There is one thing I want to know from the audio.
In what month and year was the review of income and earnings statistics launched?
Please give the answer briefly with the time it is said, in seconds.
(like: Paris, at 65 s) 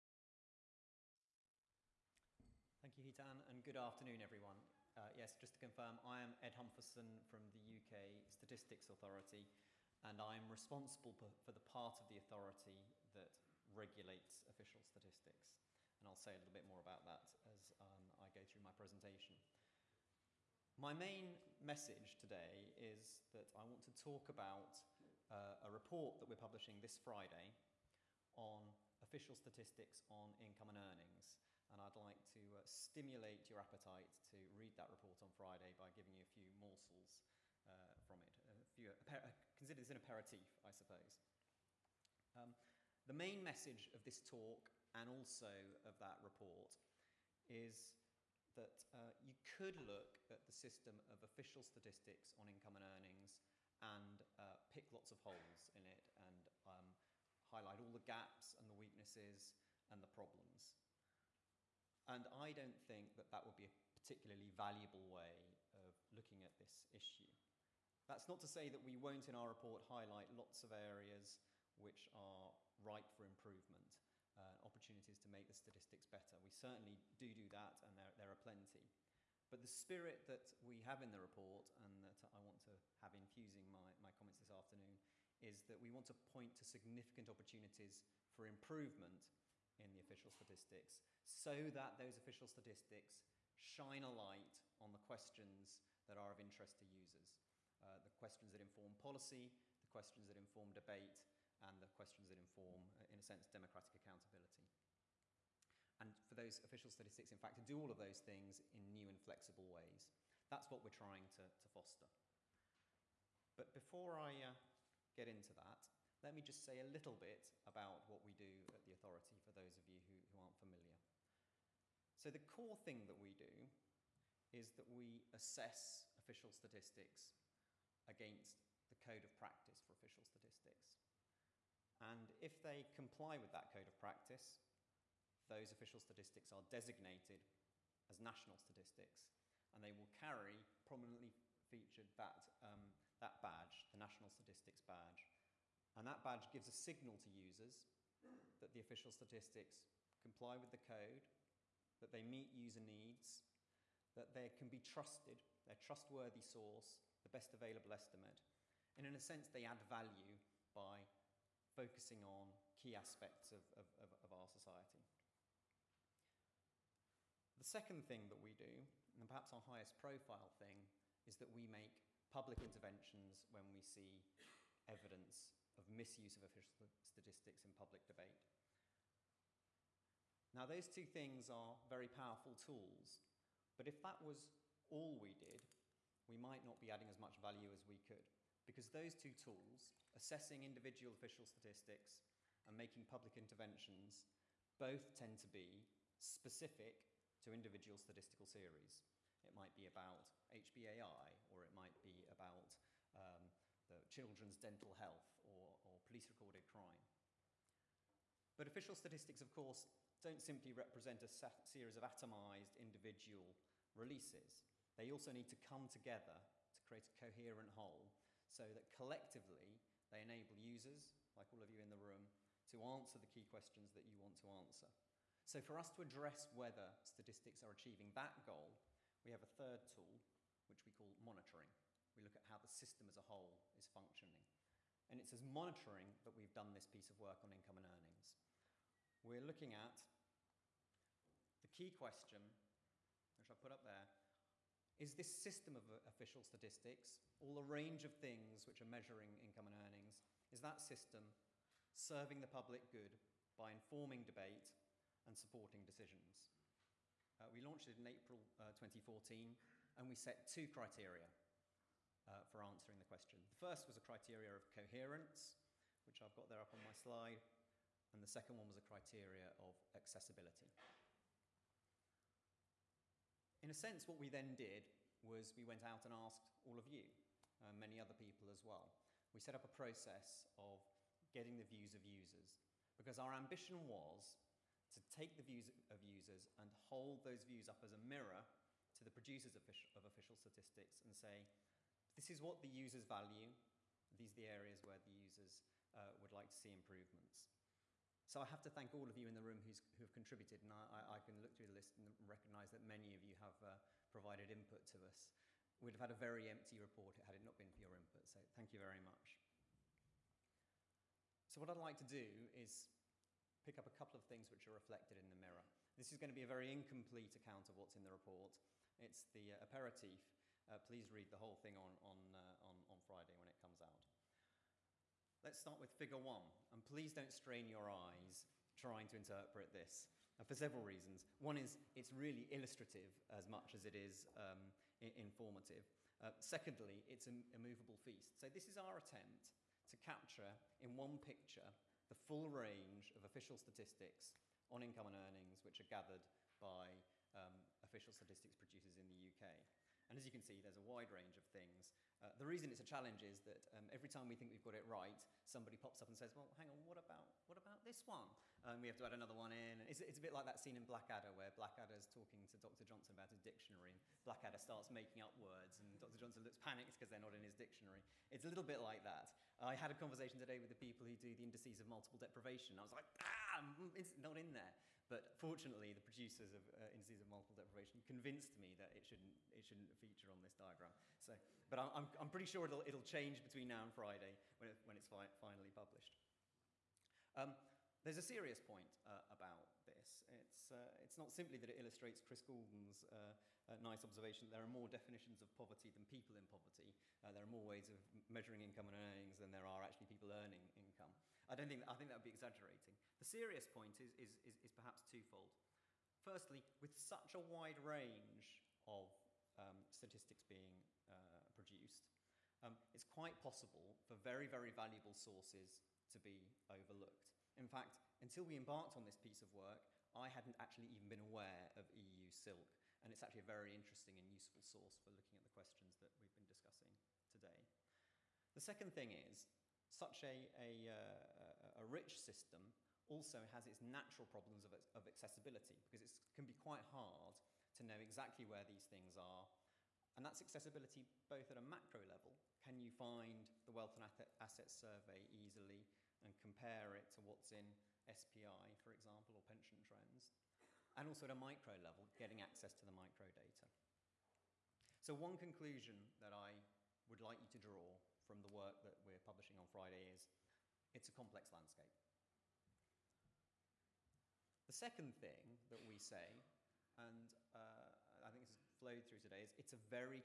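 April 2014, at 258 s.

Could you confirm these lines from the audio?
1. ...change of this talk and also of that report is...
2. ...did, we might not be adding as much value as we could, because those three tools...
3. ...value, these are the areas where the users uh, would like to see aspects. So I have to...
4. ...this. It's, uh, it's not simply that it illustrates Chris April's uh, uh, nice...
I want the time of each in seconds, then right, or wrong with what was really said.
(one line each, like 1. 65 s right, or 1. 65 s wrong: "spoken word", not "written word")
1. 43 s wrong: "message", not "change"
2. 185 s wrong: "two", not "three"
3. 293 s wrong: "improvements", not "aspects"
4. 389 s wrong: "Goulden", not "April".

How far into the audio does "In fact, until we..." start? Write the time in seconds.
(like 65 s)
417 s.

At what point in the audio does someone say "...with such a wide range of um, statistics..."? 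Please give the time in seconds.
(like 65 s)
406 s.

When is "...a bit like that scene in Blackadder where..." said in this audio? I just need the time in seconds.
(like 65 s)
360 s.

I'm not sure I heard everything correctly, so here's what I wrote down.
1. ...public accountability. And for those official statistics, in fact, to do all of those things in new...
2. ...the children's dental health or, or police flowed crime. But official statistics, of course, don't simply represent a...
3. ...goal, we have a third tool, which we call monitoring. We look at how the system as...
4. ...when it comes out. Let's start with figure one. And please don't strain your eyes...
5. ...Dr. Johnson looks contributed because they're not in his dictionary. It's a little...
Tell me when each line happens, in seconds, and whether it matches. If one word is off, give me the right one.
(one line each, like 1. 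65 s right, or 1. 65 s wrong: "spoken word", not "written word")
1. 103 s wrong: "democratic", not "public"
2. 203 s wrong: "recorded", not "flowed"
3. 228 s right
4. 323 s right
5. 365 s wrong: "panicked", not "contributed".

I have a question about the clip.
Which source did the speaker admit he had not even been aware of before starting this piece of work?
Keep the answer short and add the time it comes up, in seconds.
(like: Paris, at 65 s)
EU SILC, at 421 s.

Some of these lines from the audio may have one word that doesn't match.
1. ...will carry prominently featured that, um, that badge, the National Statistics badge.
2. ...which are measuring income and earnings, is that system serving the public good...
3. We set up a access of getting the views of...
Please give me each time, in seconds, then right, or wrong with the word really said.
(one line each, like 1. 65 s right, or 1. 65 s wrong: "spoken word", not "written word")
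1. 139 s right
2. 248 s right
3. 279 s wrong: "process", not "access".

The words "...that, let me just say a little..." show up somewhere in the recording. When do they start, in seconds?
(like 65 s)
115 s.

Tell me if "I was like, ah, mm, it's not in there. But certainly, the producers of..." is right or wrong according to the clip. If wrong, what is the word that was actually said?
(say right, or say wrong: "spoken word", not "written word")
wrong: "fortunately", not "certainly".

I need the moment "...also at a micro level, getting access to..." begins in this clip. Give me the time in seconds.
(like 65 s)
451 s.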